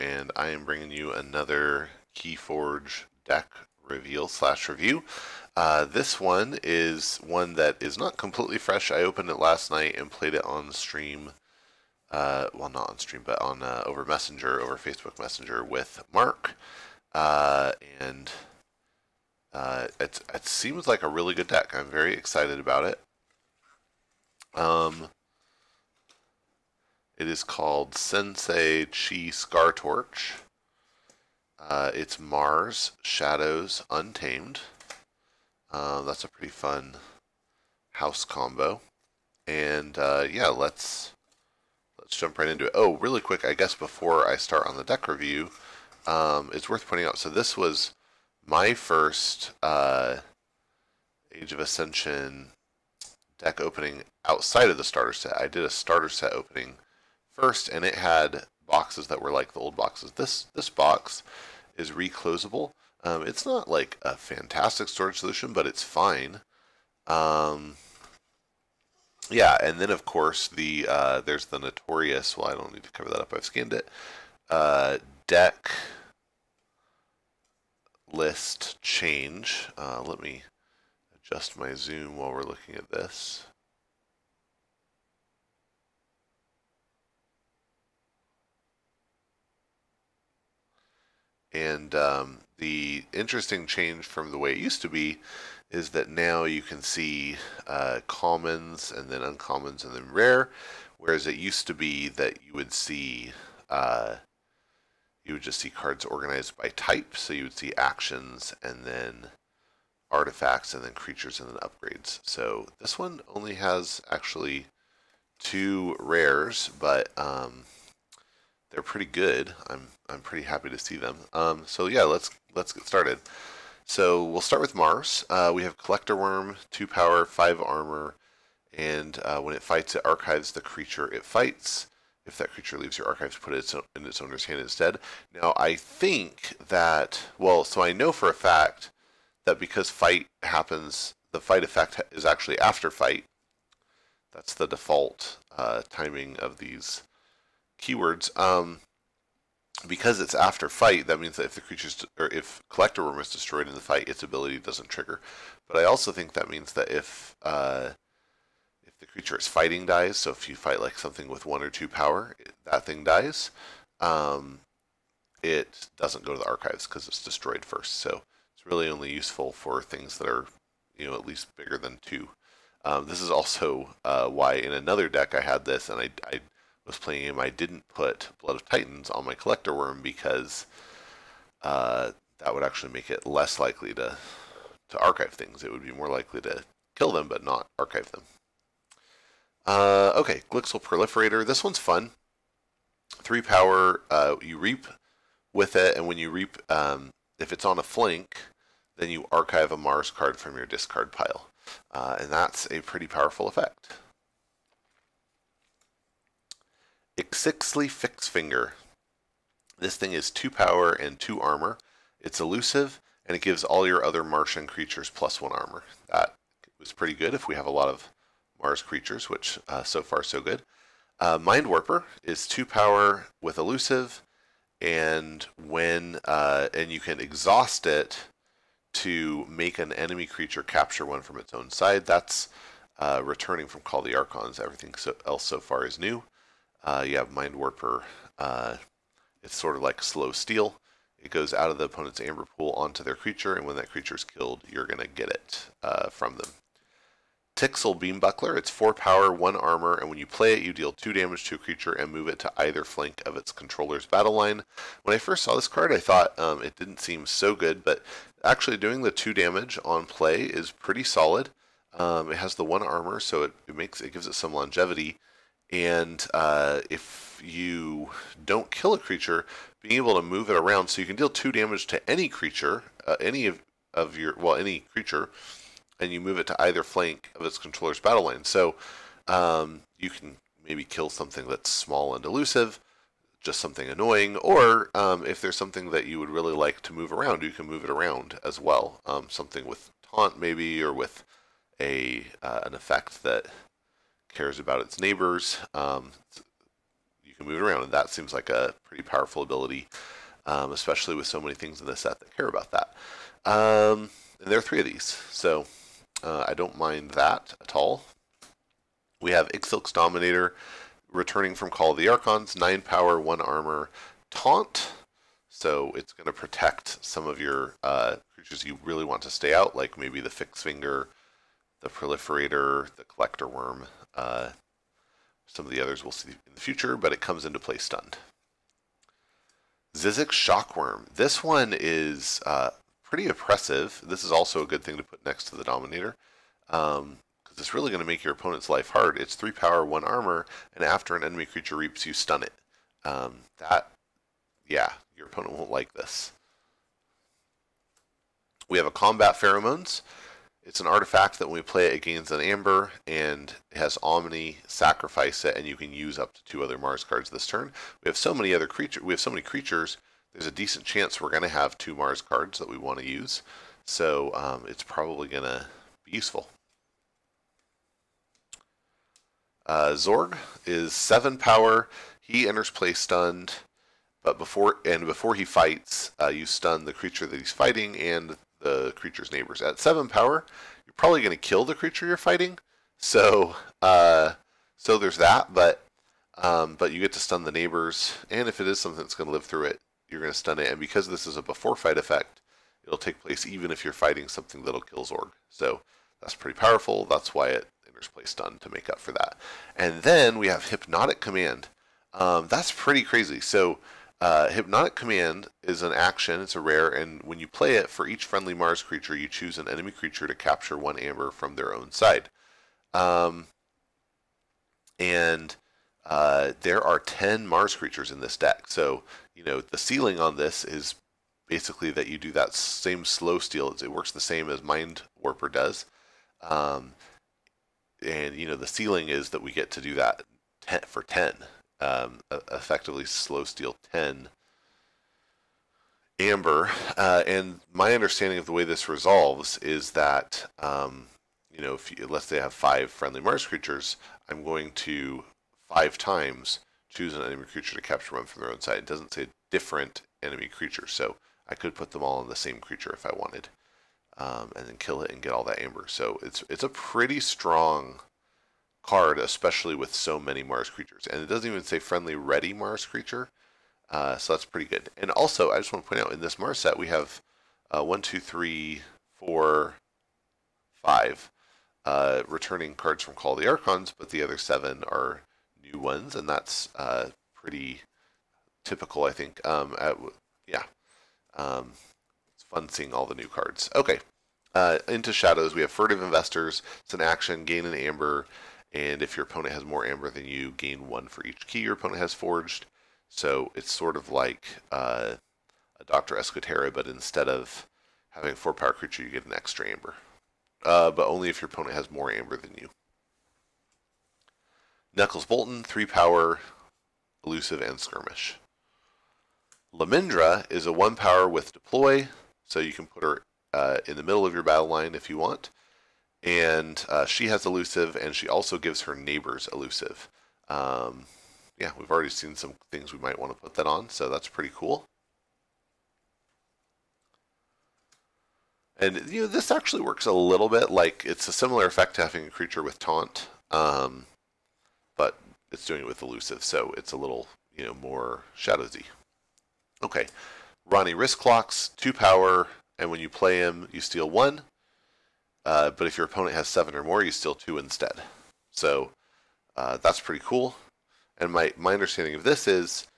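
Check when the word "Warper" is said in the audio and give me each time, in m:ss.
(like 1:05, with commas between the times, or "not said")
3:41, 3:57, 7:05.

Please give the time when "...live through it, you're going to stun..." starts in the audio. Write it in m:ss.
6:29.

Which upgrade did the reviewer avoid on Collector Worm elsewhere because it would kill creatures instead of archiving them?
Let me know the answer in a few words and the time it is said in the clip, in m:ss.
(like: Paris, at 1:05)
Blood of Titans, at 2:58.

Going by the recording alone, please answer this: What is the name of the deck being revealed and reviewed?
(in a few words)
Sensei Chi Scar Torch.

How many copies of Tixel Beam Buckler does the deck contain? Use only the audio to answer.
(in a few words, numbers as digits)
3.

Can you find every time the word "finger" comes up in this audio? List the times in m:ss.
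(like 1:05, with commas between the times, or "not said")
3:28, 5:20.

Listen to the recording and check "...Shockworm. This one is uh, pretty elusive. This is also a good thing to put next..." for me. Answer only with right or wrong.
wrong.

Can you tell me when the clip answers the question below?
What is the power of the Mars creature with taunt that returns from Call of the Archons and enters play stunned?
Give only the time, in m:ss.
5:12.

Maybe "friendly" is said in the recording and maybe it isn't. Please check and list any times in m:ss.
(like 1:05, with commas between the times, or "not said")
6:48, 7:22, 7:41.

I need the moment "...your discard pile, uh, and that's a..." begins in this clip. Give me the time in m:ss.
3:20.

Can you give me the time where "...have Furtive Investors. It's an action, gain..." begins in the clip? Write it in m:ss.
8:05.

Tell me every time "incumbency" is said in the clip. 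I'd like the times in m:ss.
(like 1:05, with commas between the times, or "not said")
not said.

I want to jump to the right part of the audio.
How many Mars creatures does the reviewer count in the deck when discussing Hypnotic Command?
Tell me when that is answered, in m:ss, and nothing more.
6:57.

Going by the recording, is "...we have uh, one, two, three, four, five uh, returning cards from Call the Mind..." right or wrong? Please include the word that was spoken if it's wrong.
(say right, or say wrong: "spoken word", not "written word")
wrong: "Archons", not "Mind".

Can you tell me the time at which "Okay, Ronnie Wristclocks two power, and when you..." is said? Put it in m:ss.
8:59.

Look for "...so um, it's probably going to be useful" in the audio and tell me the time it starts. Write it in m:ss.
6:03.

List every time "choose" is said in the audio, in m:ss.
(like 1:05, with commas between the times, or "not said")
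6:49, 7:26.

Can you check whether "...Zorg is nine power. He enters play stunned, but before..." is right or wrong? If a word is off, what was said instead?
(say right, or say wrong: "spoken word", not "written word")
wrong: "seven", not "nine".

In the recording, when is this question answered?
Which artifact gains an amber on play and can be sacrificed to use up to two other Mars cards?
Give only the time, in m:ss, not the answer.
5:48.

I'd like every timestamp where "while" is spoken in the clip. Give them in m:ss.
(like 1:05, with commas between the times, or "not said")
1:22.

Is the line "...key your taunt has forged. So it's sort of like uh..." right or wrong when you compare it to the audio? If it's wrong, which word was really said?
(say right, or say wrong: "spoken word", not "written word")
wrong: "opponent", not "taunt".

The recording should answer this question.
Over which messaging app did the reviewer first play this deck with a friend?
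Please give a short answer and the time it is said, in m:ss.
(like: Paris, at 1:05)
Facebook Messenger, at 0:14.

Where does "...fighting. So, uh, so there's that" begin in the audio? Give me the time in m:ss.
6:22.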